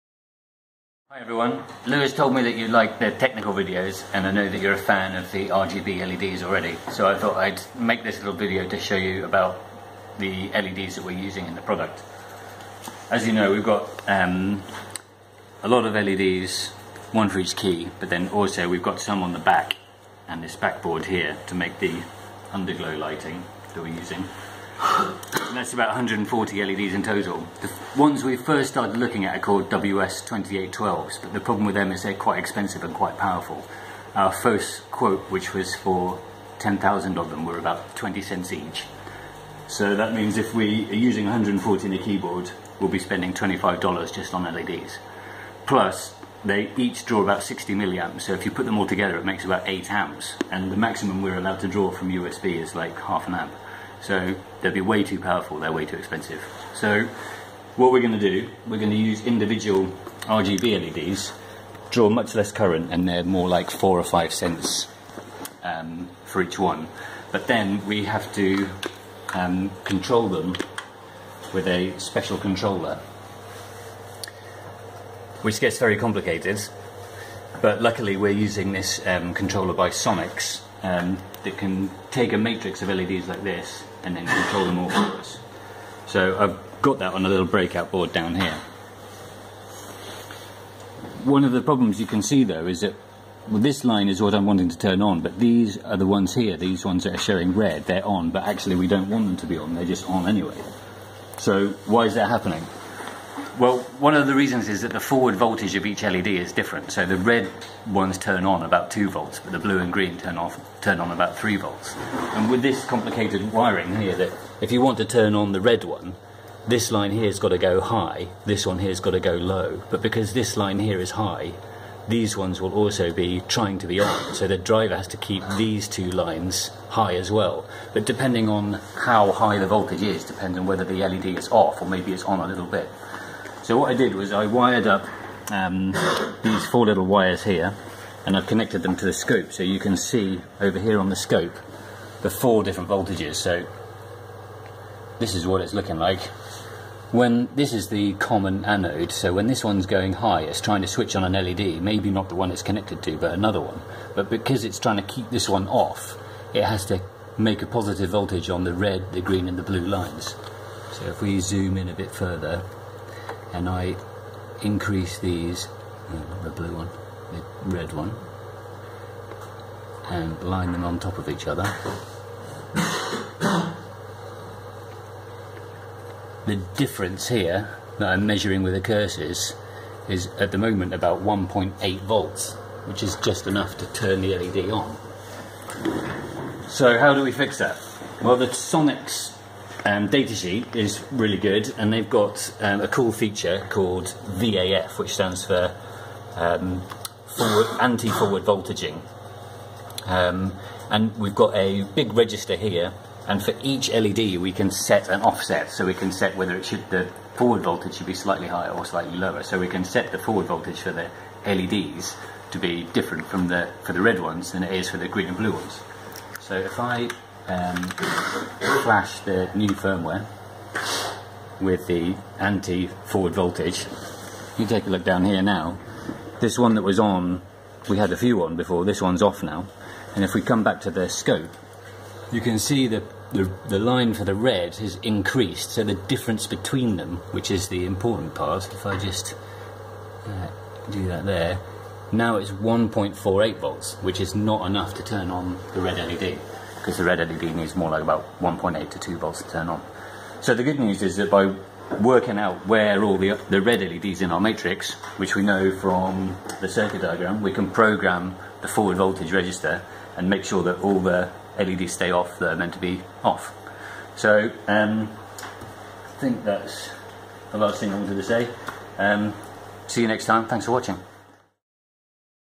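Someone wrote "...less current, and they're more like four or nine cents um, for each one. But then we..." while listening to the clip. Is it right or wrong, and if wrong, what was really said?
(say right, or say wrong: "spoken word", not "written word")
wrong: "five", not "nine".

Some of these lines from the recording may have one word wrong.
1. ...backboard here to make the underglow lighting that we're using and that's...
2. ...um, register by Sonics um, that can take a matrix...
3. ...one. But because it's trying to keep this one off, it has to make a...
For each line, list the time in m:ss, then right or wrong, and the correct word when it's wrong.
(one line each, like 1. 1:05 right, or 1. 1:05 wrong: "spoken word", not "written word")
1. 0:20 right
2. 1:19 wrong: "controller", not "register"
3. 2:33 right.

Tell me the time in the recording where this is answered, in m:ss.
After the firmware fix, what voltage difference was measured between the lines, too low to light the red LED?
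4:02.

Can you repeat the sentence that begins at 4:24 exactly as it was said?
So um, I think that's the last thing I wanted to say.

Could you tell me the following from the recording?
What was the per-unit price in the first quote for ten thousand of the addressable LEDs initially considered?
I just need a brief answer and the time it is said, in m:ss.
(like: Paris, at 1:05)
20 cents, at 0:37.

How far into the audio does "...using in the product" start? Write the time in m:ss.
0:11.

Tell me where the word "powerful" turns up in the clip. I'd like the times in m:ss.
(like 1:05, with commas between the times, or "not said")
0:33, 0:55.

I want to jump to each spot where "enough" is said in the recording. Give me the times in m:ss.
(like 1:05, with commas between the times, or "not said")
3:03, 4:04.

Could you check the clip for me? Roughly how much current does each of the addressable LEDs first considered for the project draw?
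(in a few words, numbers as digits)
60 milliamps.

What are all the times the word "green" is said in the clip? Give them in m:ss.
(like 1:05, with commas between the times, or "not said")
1:49, 2:39, 3:35.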